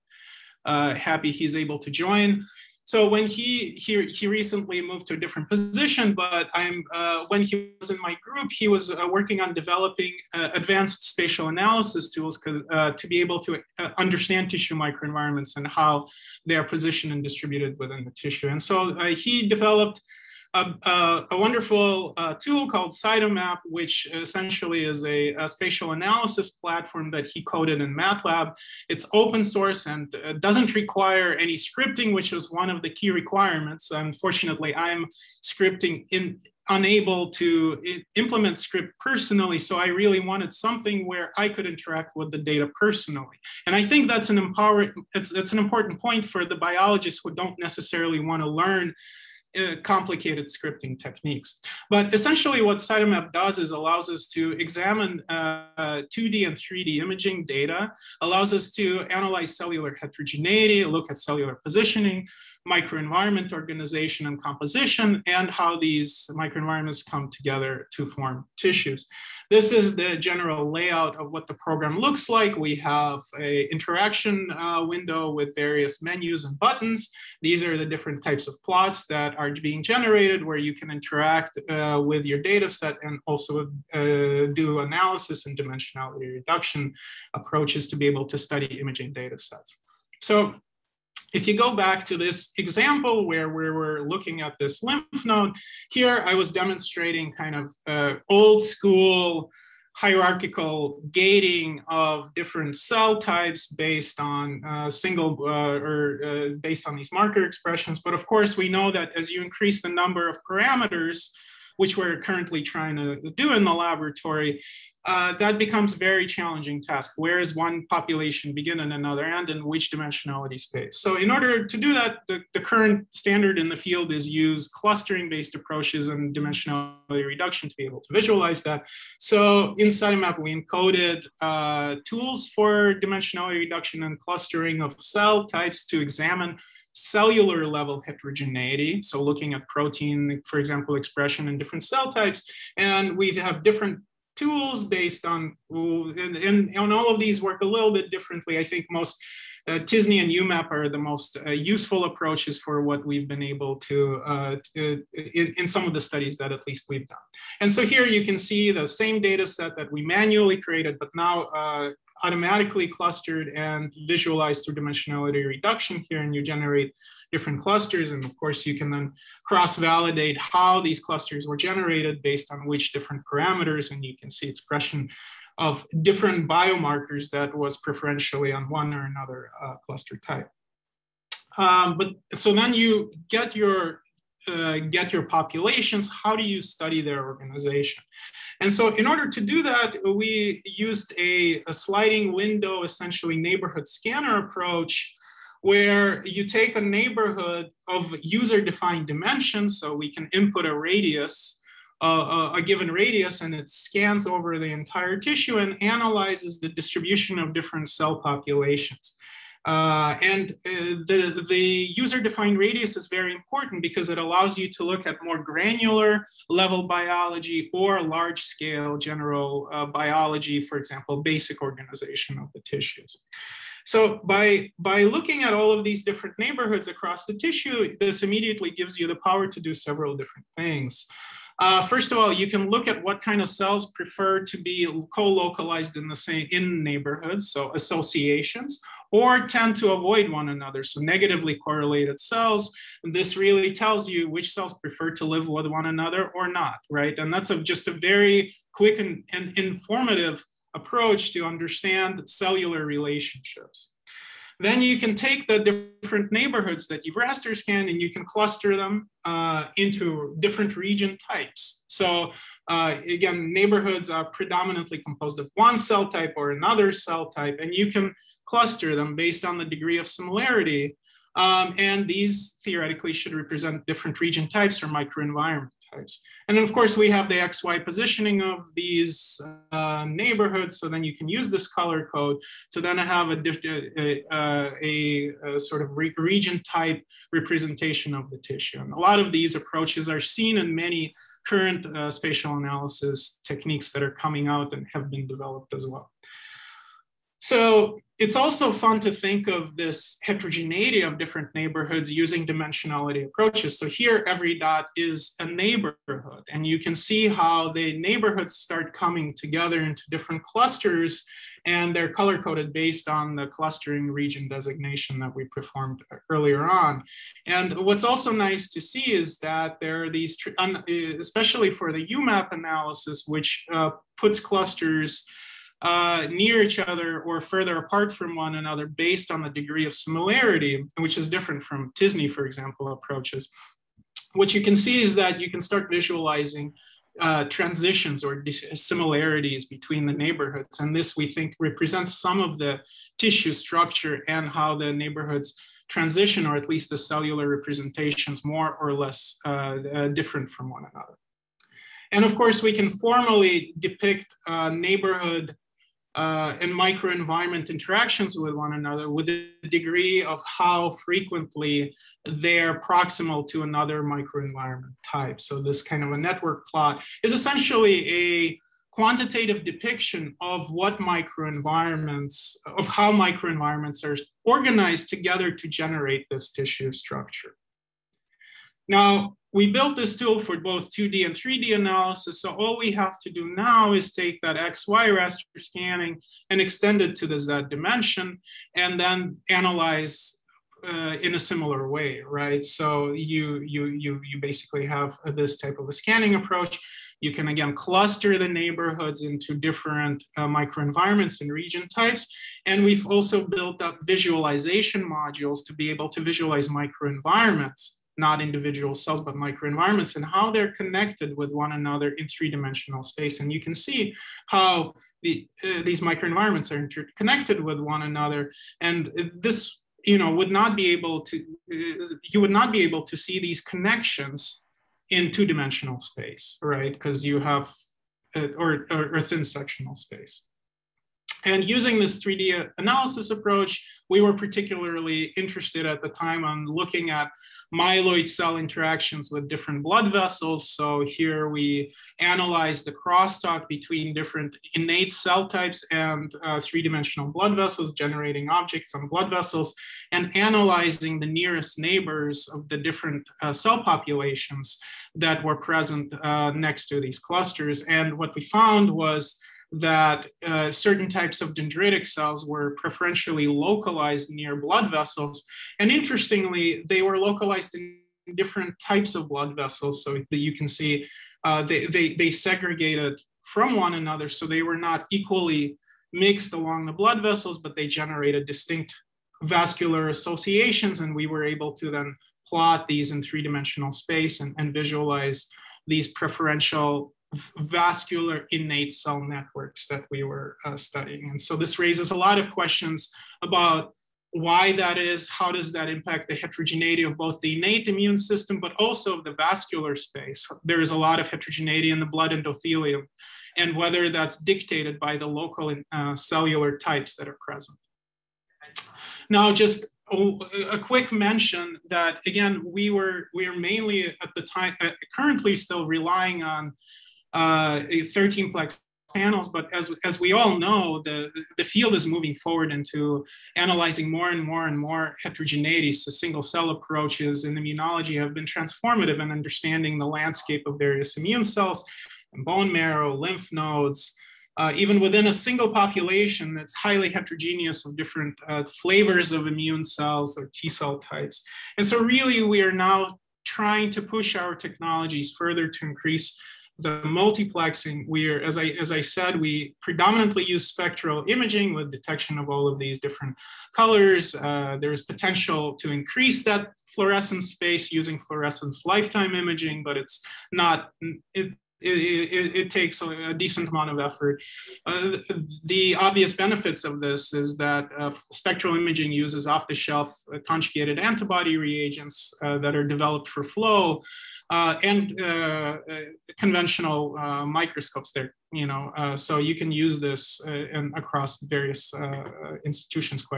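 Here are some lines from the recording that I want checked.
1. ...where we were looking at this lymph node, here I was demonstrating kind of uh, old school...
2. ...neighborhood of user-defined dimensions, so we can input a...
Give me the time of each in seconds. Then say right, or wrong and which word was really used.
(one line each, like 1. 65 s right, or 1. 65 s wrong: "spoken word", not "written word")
1. 93 s right
2. 196 s right.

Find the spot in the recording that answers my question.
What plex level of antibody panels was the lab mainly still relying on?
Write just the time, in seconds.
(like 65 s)
518 s.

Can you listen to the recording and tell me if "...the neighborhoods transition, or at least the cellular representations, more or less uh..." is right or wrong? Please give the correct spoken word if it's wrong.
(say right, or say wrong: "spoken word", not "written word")
right.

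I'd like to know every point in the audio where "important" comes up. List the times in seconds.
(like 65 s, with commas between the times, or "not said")
45 s, 213 s.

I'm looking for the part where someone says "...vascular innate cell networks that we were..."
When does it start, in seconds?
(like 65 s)
487 s.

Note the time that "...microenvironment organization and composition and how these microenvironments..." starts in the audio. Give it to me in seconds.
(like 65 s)
62 s.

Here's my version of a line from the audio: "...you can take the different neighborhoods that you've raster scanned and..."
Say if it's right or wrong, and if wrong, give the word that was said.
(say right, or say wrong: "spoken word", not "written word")
right.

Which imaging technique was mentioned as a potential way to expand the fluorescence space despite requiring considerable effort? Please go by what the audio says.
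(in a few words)
fluorescence lifetime imaging.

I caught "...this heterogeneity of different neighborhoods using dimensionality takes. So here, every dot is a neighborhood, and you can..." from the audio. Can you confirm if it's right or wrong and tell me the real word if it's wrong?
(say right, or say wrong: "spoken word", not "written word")
wrong: "approaches", not "takes".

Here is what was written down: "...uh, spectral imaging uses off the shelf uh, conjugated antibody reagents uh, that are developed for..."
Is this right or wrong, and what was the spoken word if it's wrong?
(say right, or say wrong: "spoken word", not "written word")
right.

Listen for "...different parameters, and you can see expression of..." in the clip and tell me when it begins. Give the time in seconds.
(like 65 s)
172 s.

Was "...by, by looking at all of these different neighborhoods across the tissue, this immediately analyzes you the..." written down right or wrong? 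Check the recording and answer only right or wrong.
wrong.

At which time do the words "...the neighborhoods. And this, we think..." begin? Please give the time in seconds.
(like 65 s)
340 s.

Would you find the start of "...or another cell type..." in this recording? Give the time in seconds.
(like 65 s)
266 s.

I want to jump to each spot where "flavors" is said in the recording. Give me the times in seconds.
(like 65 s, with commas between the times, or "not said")
538 s.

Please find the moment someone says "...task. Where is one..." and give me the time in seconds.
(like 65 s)
116 s.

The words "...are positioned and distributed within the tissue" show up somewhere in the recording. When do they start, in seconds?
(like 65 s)
16 s.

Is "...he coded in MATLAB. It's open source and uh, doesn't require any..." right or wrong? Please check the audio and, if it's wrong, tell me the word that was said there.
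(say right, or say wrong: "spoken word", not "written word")
right.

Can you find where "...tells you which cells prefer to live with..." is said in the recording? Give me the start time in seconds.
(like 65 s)
243 s.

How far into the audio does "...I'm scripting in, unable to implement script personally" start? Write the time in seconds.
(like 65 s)
34 s.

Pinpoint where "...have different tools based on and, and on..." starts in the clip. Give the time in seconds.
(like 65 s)
143 s.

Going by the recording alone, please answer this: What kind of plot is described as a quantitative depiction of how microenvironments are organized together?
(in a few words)
network plot.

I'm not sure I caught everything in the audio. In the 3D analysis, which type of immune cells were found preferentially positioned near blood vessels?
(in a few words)
dendritic cells.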